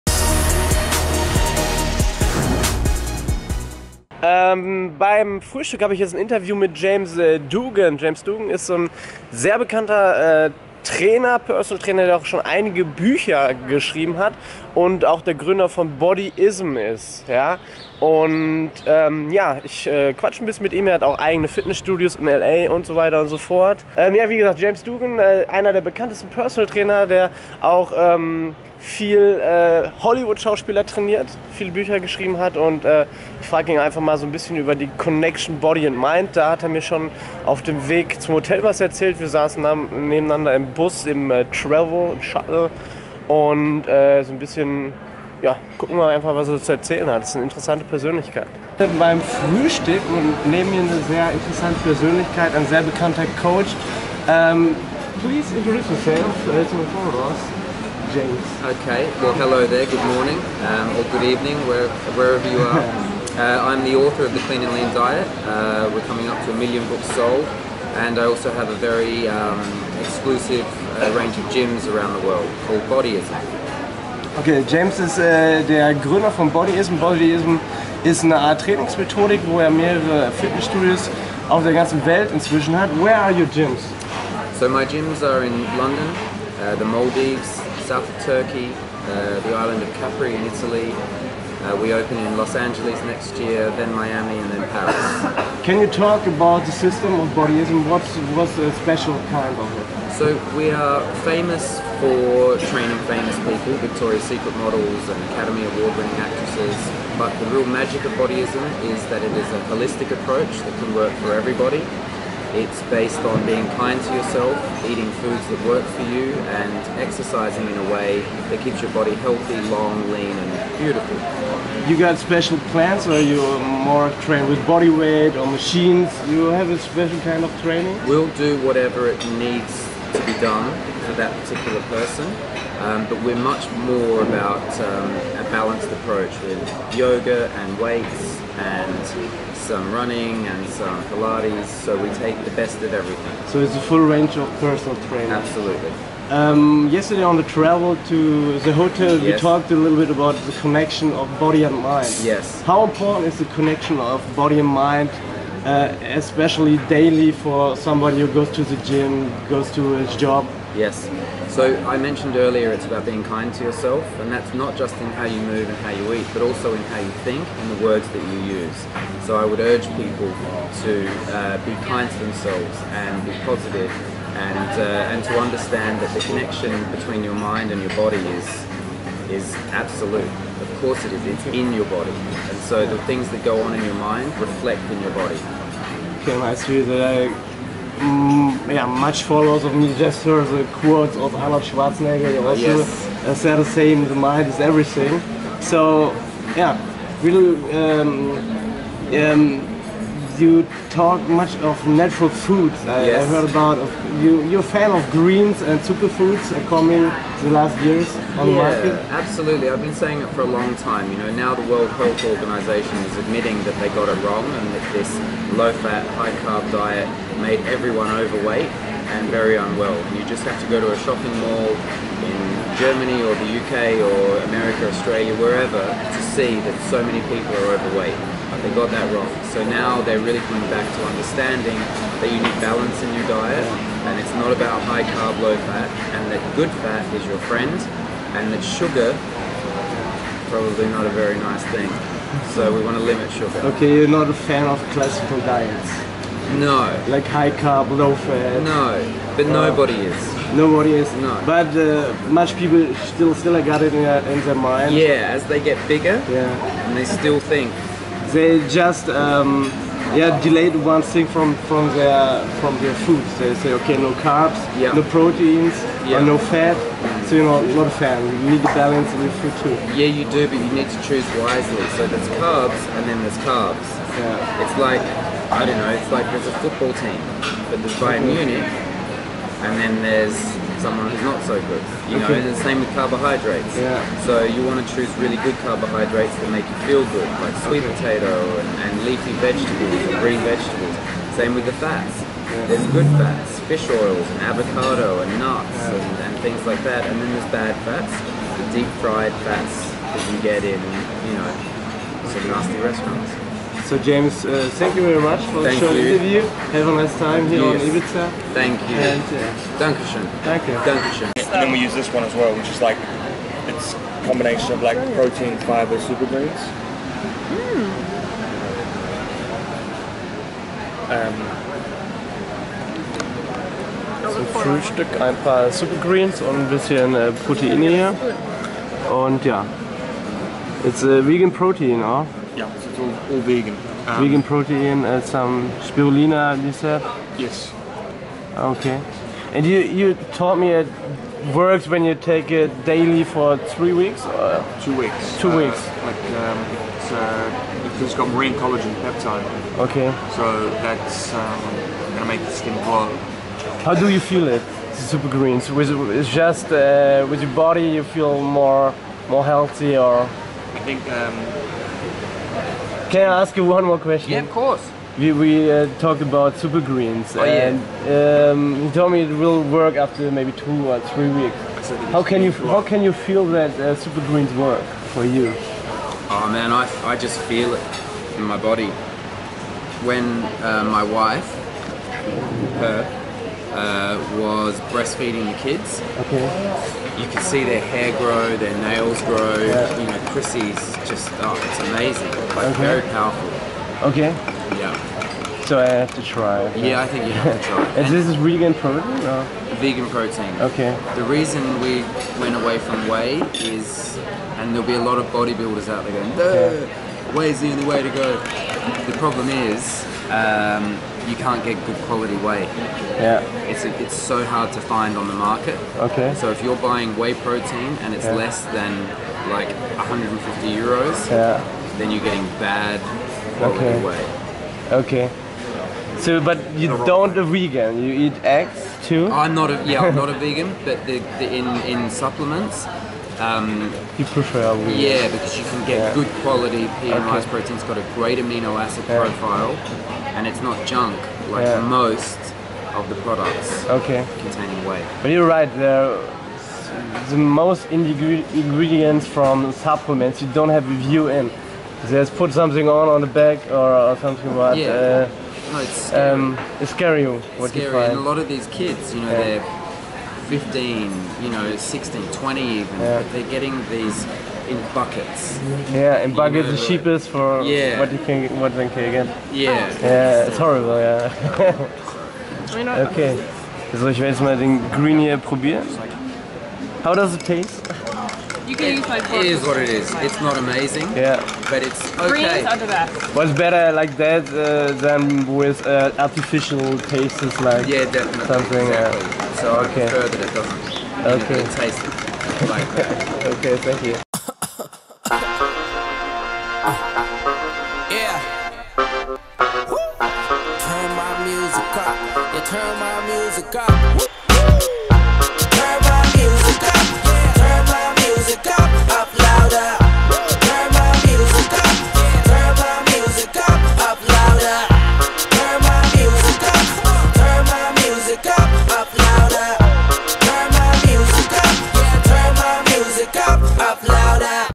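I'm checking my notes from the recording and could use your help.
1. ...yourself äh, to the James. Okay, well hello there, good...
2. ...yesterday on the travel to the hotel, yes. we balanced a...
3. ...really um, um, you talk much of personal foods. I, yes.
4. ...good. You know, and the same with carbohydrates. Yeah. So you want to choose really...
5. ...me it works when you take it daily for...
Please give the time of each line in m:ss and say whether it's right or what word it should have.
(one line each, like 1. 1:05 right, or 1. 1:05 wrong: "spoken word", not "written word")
1. 0:55 right
2. 2:26 wrong: "talked", not "balanced"
3. 3:17 wrong: "natural", not "personal"
4. 4:41 right
5. 5:40 right.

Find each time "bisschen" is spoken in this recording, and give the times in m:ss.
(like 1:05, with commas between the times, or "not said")
0:20, 0:34, 0:44, 5:26.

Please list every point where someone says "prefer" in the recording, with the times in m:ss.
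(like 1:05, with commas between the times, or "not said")
7:14, 8:10.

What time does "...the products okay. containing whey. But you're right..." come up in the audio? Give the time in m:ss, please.
7:23.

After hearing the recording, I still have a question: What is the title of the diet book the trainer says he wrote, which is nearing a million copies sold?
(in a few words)
The Clean and Lean Diet.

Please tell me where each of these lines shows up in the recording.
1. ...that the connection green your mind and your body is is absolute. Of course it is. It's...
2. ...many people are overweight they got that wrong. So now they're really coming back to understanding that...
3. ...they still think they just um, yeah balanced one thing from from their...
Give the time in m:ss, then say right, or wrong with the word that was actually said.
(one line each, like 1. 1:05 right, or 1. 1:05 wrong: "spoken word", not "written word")
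1. 2:56 wrong: "between", not "green"
2. 3:47 right
3. 4:16 wrong: "delayed", not "balanced".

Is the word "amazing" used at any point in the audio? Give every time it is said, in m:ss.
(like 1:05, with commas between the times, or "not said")
6:31, 8:00.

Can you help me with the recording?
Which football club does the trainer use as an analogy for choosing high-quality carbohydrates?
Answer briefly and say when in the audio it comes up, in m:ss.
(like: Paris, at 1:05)
Bayern Munich, at 4:37.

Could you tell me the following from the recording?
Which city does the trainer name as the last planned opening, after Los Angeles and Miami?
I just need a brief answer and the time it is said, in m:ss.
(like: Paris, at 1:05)
Paris, at 1:34.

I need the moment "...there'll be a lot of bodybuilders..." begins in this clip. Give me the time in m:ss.
6:44.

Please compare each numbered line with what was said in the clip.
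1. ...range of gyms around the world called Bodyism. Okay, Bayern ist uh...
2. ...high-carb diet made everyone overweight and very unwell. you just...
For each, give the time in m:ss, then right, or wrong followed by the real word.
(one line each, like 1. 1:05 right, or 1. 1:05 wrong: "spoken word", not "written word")
1. 1:11 wrong: "James", not "Bayern"
2. 3:36 right.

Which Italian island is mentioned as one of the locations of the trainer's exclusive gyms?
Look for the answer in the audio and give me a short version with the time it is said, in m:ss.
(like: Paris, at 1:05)
Capri, at 1:29.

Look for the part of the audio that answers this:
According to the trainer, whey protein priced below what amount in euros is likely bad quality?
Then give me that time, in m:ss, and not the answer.
6:59.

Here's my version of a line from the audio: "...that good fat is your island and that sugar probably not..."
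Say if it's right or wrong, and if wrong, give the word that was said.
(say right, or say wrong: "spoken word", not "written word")
wrong: "friend", not "island".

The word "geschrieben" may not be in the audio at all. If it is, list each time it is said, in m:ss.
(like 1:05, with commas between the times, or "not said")
0:13, 0:31.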